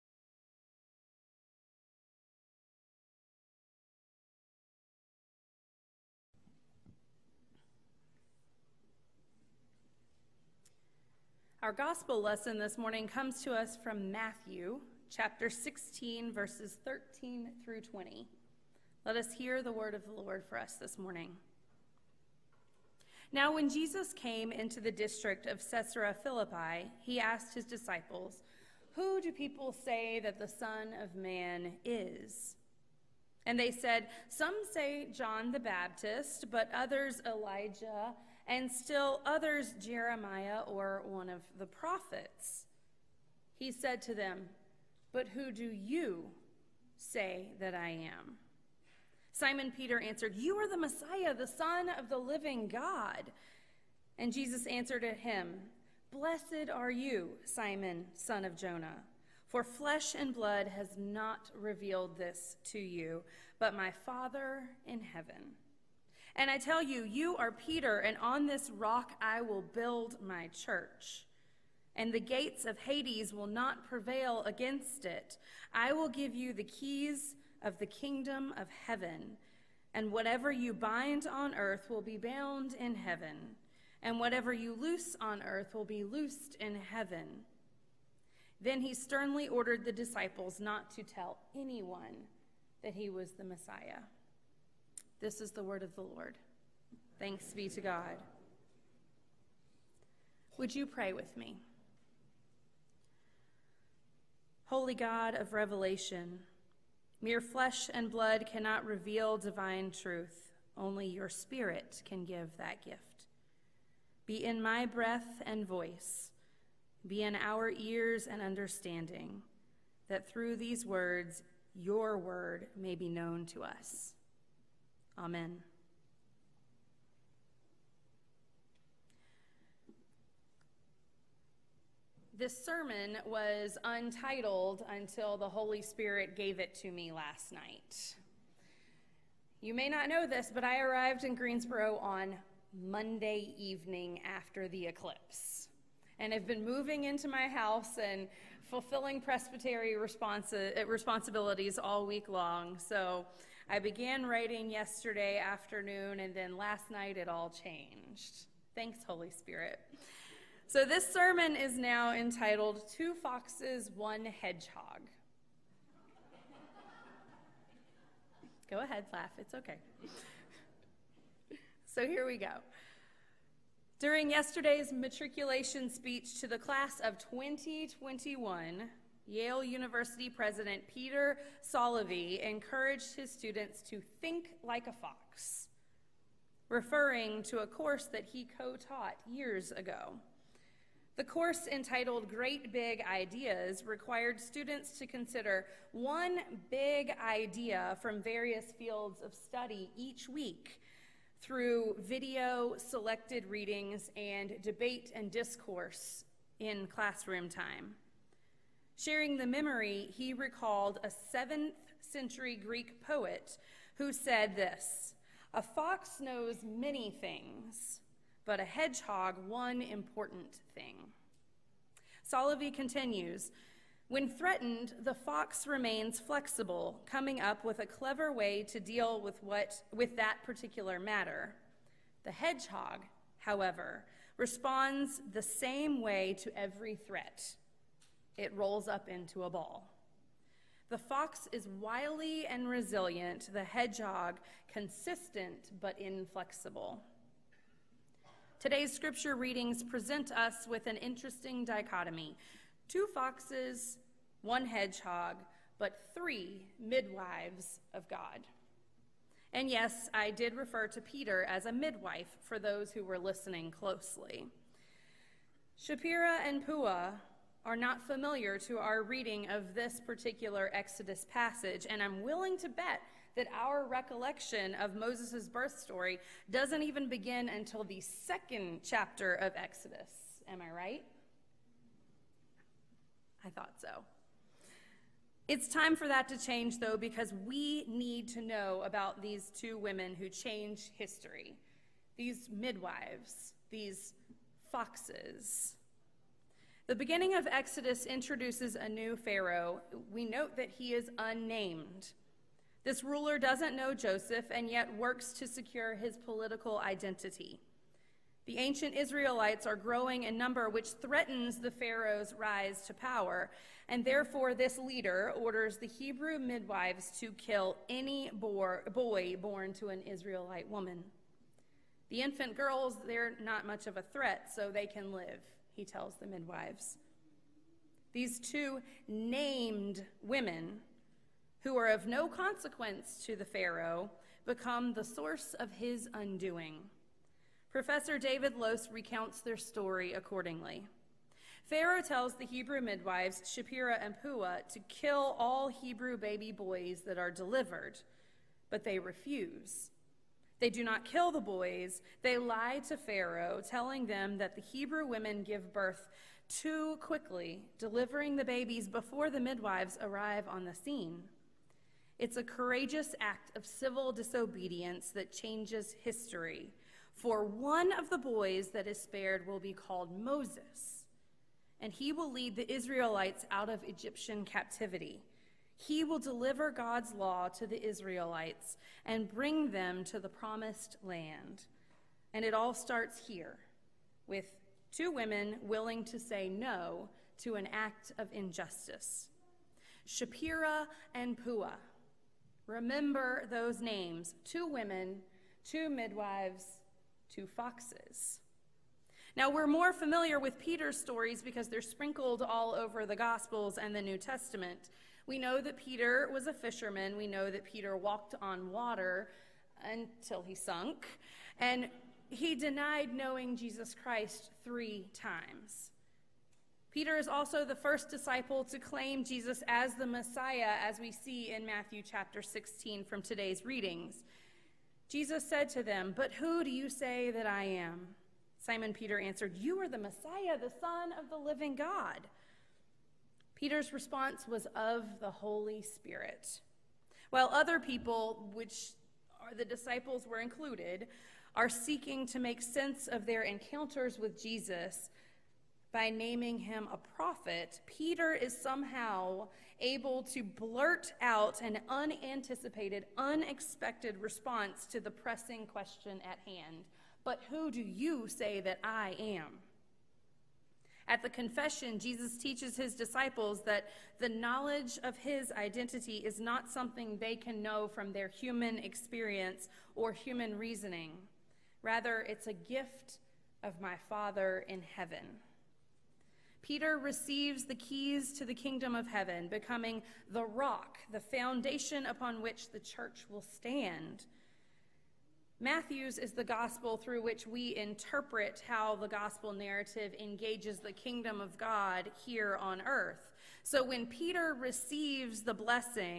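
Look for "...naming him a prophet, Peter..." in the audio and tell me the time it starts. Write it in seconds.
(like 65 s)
446 s.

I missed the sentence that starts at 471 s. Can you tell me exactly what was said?
Rather, it's a gift of my Father in heaven.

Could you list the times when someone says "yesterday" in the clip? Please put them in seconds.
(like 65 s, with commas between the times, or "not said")
154 s, 174 s.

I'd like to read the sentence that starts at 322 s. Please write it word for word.
The infant girls, they're not much of a threat, so they can live he tells the midwives.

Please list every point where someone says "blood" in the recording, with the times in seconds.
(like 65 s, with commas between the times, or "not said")
60 s, 108 s.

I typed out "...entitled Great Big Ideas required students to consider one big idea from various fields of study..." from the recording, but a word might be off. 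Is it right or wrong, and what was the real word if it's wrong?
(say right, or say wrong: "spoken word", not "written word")
right.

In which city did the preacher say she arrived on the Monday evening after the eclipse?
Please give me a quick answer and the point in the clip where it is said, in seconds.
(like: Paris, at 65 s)
Greensboro, at 141 s.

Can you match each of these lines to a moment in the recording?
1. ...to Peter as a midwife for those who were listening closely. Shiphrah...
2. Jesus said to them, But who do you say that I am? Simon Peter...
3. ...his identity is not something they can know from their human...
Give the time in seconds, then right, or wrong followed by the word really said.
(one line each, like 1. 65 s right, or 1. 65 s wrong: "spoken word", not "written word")
1. 260 s right
2. 425 s right
3. 465 s right.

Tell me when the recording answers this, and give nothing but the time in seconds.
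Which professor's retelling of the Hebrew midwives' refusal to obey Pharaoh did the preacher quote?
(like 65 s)
338 s.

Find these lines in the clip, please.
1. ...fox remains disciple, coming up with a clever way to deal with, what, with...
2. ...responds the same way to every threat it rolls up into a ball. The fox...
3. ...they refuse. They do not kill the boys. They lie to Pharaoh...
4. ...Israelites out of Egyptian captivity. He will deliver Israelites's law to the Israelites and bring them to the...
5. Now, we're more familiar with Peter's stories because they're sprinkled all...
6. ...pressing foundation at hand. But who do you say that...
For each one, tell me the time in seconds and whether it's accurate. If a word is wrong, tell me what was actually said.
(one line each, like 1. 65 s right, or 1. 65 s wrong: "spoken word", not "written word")
1. 225 s wrong: "flexible", not "disciple"
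2. 234 s right
3. 348 s right
4. 372 s wrong: "God", not "Israelites"
5. 399 s right
6. 455 s wrong: "question", not "foundation".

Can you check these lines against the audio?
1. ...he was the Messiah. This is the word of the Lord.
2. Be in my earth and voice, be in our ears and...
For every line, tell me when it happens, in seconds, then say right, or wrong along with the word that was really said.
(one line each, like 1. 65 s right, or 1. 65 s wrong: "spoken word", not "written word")
1. 92 s right
2. 114 s wrong: "breath", not "earth".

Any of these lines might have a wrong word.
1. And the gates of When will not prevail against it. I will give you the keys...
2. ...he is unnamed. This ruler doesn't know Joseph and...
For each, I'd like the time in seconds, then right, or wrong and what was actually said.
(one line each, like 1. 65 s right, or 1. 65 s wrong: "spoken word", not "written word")
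1. 71 s wrong: "Hades", not "When"
2. 300 s right.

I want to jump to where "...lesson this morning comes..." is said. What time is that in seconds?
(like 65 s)
12 s.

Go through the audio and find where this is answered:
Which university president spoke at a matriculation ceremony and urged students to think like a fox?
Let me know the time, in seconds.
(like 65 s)
180 s.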